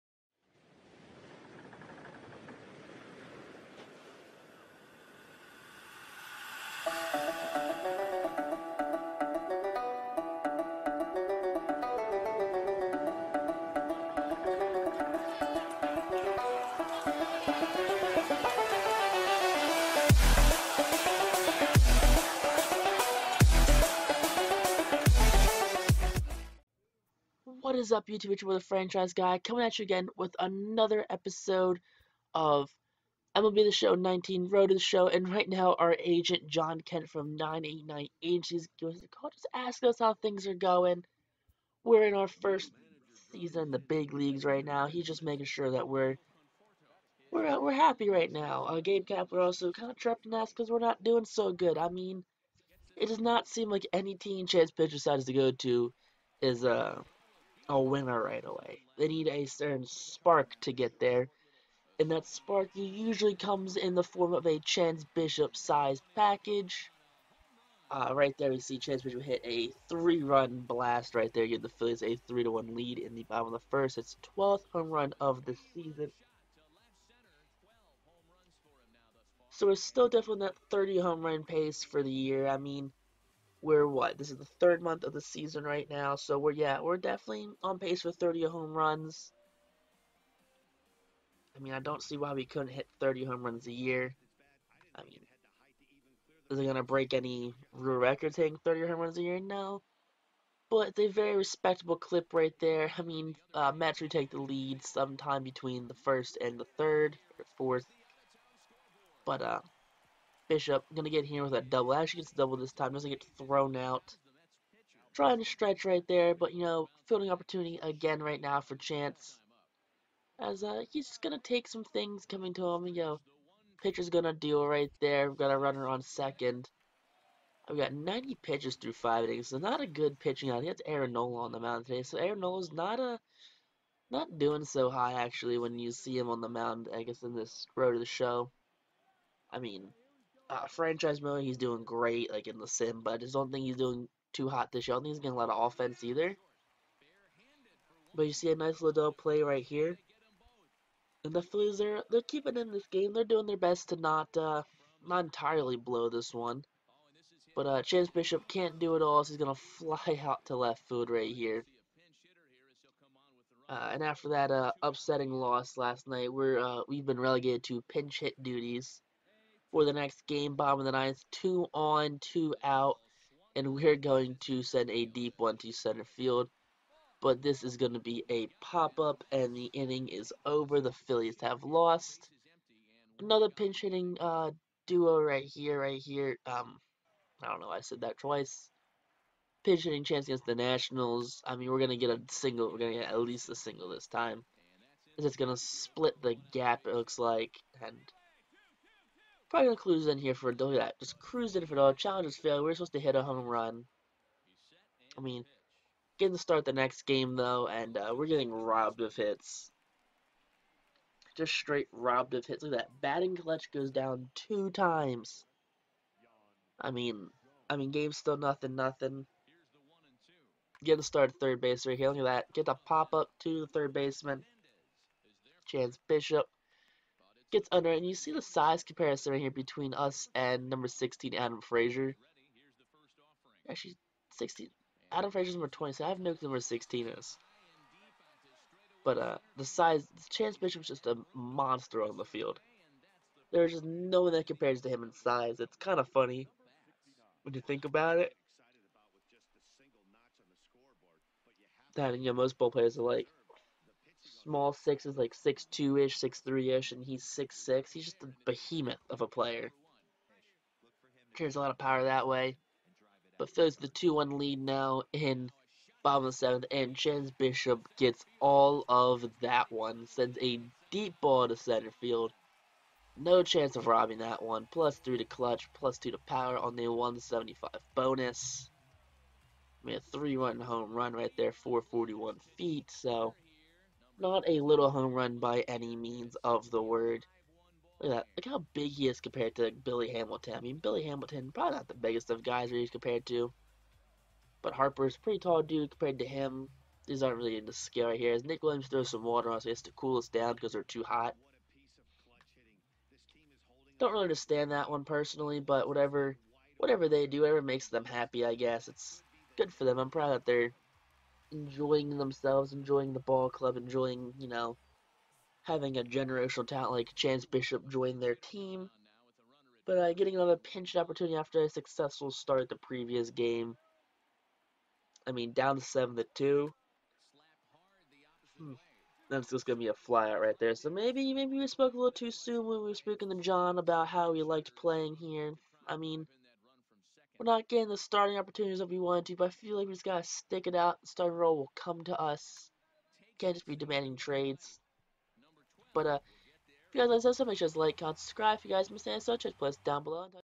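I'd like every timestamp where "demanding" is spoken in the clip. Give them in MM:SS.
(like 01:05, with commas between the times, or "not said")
05:43.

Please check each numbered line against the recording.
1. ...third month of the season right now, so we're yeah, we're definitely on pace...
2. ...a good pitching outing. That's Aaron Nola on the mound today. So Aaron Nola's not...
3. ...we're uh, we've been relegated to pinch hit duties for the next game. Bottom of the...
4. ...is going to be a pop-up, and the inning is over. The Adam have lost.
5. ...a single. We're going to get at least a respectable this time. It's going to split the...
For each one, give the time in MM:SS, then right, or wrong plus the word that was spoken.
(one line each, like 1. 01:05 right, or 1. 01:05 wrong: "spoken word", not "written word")
1. 01:24 right
2. 02:09 right
3. 02:46 right
4. 02:57 wrong: "Phillies", not "Adam"
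5. 03:12 wrong: "single", not "respectable".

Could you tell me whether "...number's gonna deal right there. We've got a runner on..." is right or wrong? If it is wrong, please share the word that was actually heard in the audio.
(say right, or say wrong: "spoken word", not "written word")
wrong: "pitcher", not "number".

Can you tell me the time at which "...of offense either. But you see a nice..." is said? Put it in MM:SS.
02:25.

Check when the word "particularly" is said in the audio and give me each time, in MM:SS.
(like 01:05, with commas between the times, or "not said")
not said.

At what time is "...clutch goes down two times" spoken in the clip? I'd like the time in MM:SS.
03:33.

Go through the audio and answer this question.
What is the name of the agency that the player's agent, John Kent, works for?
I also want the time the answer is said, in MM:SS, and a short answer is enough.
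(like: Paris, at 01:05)
989 Agencies, at 00:37.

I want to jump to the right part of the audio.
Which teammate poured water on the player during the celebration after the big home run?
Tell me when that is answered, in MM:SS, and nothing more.
04:58.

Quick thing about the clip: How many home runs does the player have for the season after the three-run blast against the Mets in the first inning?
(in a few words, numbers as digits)
12.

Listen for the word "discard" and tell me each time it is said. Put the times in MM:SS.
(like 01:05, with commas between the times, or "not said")
not said.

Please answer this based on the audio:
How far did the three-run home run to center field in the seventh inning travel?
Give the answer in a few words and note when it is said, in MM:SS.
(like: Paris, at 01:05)
441 feet, at 04:41.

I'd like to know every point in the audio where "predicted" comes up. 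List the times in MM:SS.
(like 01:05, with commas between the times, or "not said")
not said.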